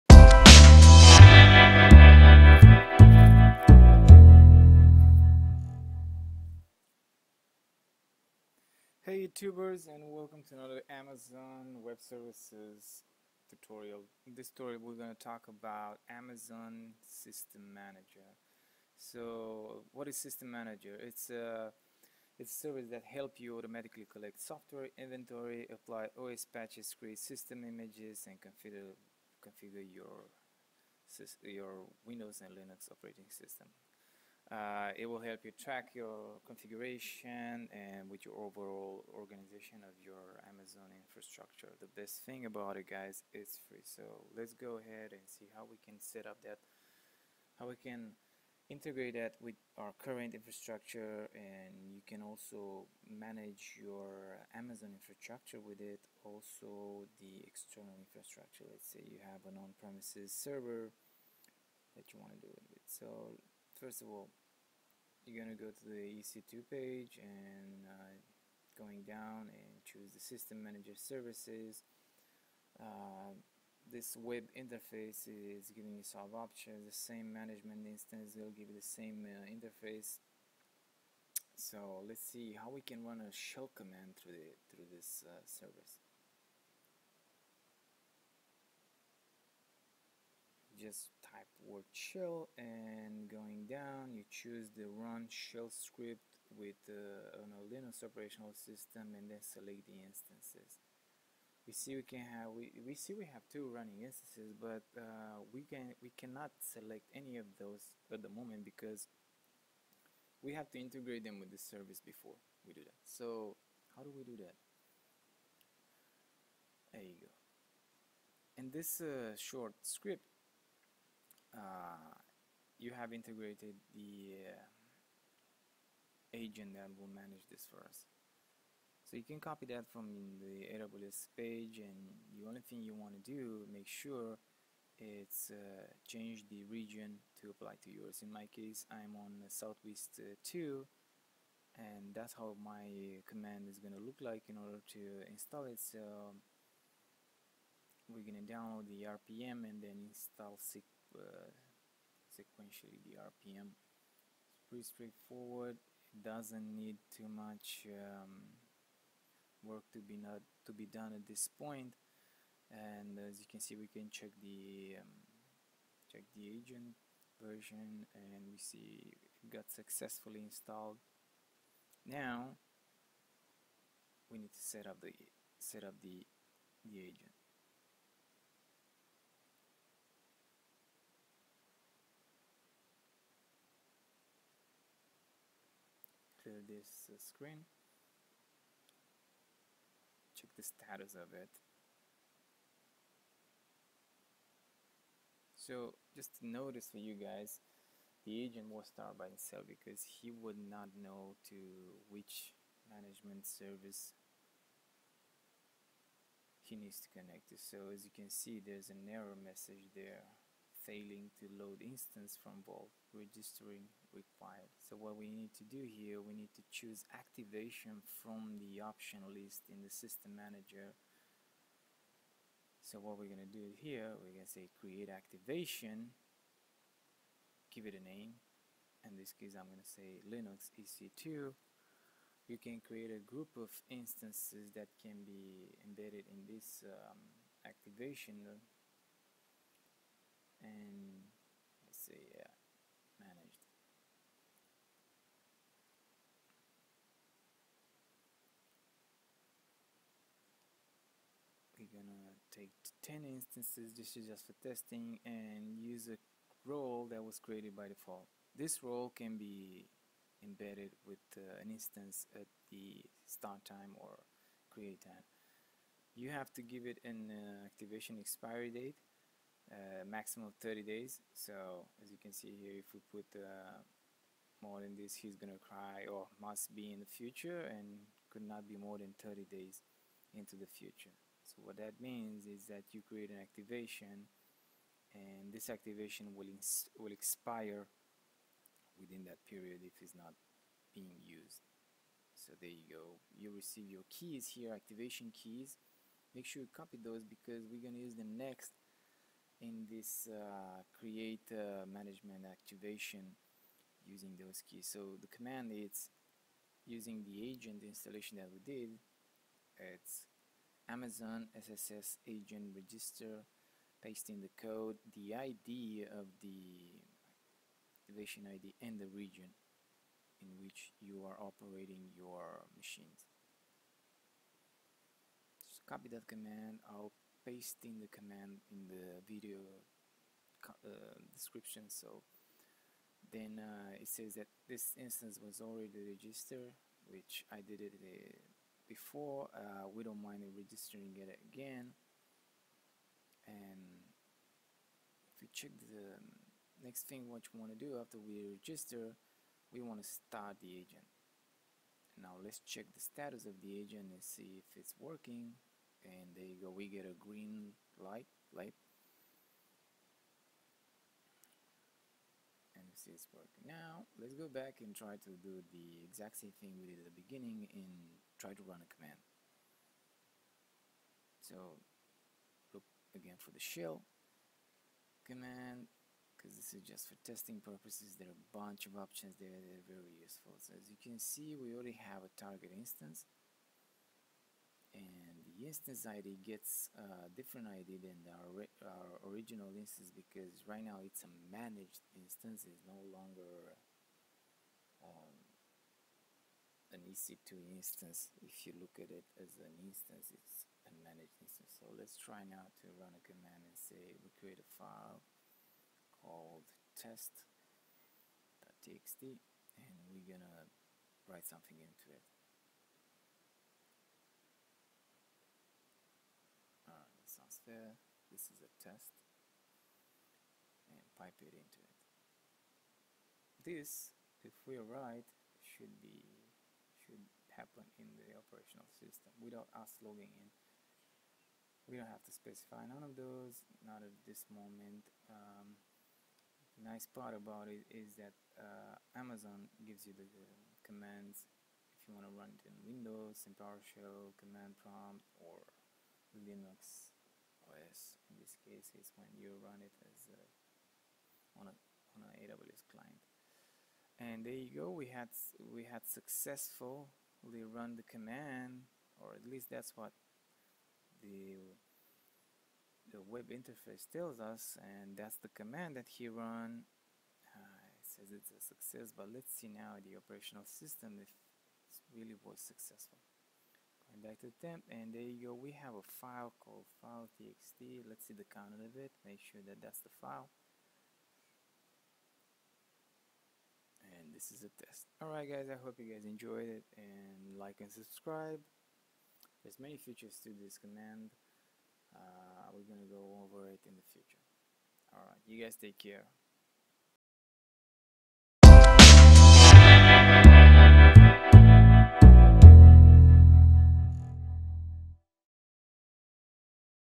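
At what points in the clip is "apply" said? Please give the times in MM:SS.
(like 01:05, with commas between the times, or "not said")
00:25, 02:17.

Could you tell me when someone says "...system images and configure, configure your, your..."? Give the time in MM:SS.
00:27.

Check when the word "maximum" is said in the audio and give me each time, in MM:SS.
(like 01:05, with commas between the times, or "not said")
04:30.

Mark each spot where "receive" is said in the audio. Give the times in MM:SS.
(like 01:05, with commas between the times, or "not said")
04:53.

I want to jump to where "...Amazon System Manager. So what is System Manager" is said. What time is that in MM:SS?
00:16.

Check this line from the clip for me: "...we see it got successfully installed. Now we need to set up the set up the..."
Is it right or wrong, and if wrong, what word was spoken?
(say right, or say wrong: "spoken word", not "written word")
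right.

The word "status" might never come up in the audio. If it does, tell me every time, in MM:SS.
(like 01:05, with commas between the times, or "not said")
03:10, 05:52.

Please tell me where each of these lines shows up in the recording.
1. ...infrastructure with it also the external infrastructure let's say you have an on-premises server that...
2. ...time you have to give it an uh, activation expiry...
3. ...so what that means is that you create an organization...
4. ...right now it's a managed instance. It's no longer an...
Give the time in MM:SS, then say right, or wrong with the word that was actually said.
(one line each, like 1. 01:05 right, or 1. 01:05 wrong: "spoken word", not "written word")
1. 00:54 right
2. 04:25 right
3. 04:41 wrong: "activation", not "organization"
4. 06:30 right.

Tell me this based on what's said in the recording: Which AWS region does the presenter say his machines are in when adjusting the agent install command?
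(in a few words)
Southwest 2.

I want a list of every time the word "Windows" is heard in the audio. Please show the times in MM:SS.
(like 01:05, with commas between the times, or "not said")
00:32, 07:22.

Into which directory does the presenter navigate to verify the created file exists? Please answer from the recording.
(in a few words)
temp.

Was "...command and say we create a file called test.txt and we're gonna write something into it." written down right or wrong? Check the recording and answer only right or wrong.
right.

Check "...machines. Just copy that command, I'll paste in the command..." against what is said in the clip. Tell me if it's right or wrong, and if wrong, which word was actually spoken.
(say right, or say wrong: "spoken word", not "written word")
right.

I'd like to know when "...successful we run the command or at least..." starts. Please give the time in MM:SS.
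07:36.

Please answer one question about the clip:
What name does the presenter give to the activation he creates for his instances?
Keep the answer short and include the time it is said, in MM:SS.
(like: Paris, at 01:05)
Linux EC2, at 03:50.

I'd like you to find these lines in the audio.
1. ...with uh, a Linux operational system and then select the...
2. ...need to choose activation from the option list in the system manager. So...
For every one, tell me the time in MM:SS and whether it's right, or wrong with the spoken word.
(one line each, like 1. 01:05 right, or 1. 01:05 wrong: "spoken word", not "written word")
1. 01:36 right
2. 03:36 right.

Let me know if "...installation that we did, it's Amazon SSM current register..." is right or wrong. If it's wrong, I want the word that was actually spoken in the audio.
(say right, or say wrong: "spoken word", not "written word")
wrong: "agent", not "current".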